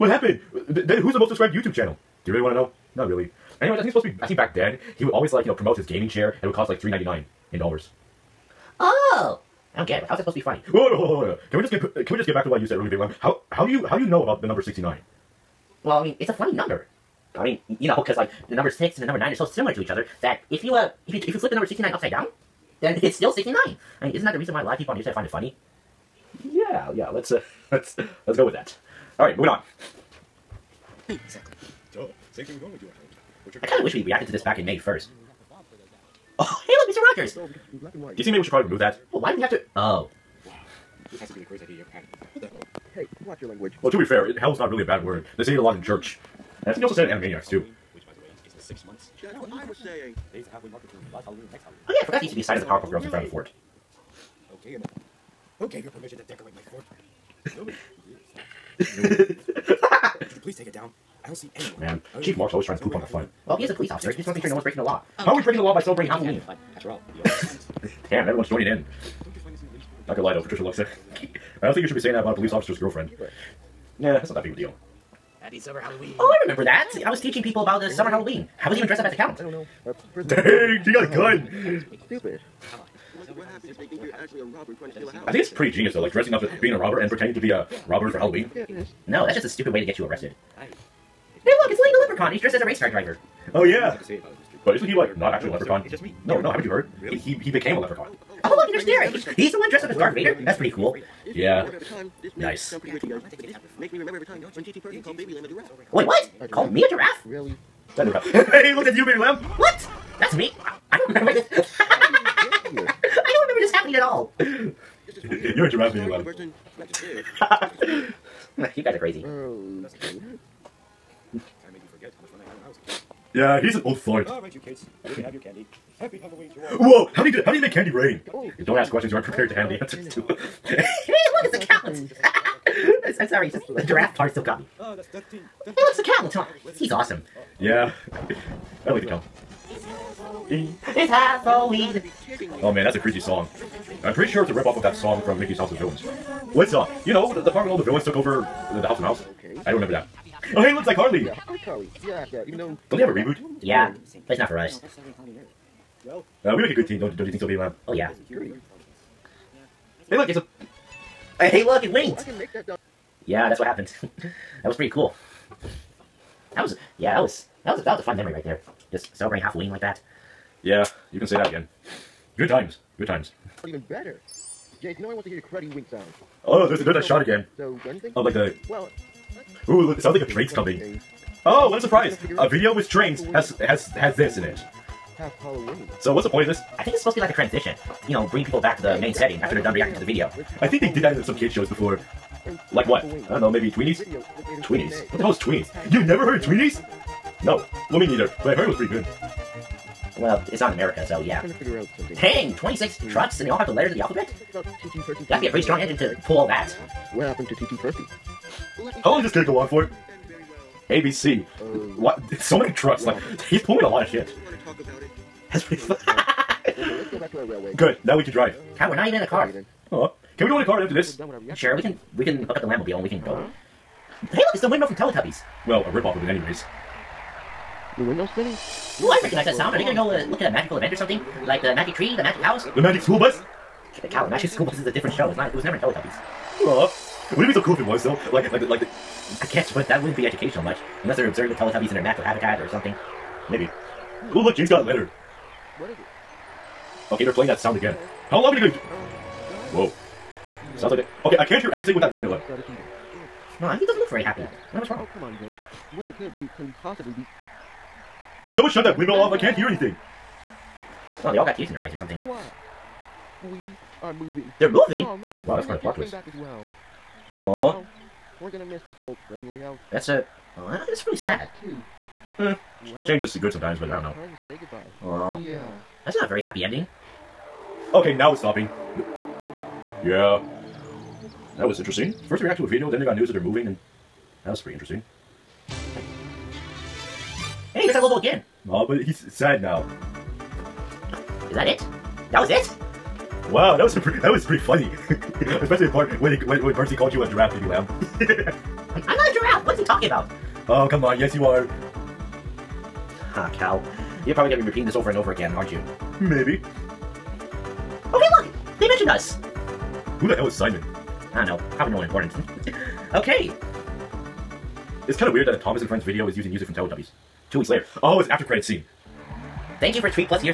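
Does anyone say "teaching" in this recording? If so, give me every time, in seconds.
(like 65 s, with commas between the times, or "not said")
77 s.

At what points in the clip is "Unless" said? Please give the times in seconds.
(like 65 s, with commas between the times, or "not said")
241 s.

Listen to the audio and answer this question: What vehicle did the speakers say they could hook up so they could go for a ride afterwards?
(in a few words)
the Lambmobile.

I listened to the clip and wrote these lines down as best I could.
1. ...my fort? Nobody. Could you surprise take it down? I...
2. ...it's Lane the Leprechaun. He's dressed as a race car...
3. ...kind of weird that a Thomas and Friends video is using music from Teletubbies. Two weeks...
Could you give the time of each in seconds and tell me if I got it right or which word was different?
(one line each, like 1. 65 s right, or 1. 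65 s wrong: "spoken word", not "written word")
1. 56 s wrong: "please", not "surprise"
2. 91 s right
3. 315 s right.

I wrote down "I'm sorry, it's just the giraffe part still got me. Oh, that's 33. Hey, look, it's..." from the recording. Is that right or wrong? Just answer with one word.
wrong.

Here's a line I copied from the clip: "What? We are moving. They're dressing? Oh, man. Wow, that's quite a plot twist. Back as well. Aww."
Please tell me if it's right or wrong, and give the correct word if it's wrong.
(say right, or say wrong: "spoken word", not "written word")
wrong: "moving", not "dressing".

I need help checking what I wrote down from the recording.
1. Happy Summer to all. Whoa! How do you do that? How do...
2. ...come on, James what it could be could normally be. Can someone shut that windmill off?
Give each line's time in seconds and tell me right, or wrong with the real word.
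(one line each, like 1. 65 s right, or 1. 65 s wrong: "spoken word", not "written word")
1. 125 s wrong: "Halloween", not "Summer"
2. 255 s wrong: "possibly", not "normally".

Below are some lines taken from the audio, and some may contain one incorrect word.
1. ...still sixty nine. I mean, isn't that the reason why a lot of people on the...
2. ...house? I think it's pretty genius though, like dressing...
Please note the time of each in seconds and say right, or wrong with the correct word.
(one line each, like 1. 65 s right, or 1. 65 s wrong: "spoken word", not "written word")
1. 23 s right
2. 85 s right.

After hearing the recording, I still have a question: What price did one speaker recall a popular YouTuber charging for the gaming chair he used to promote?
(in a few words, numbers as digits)
399 dollars.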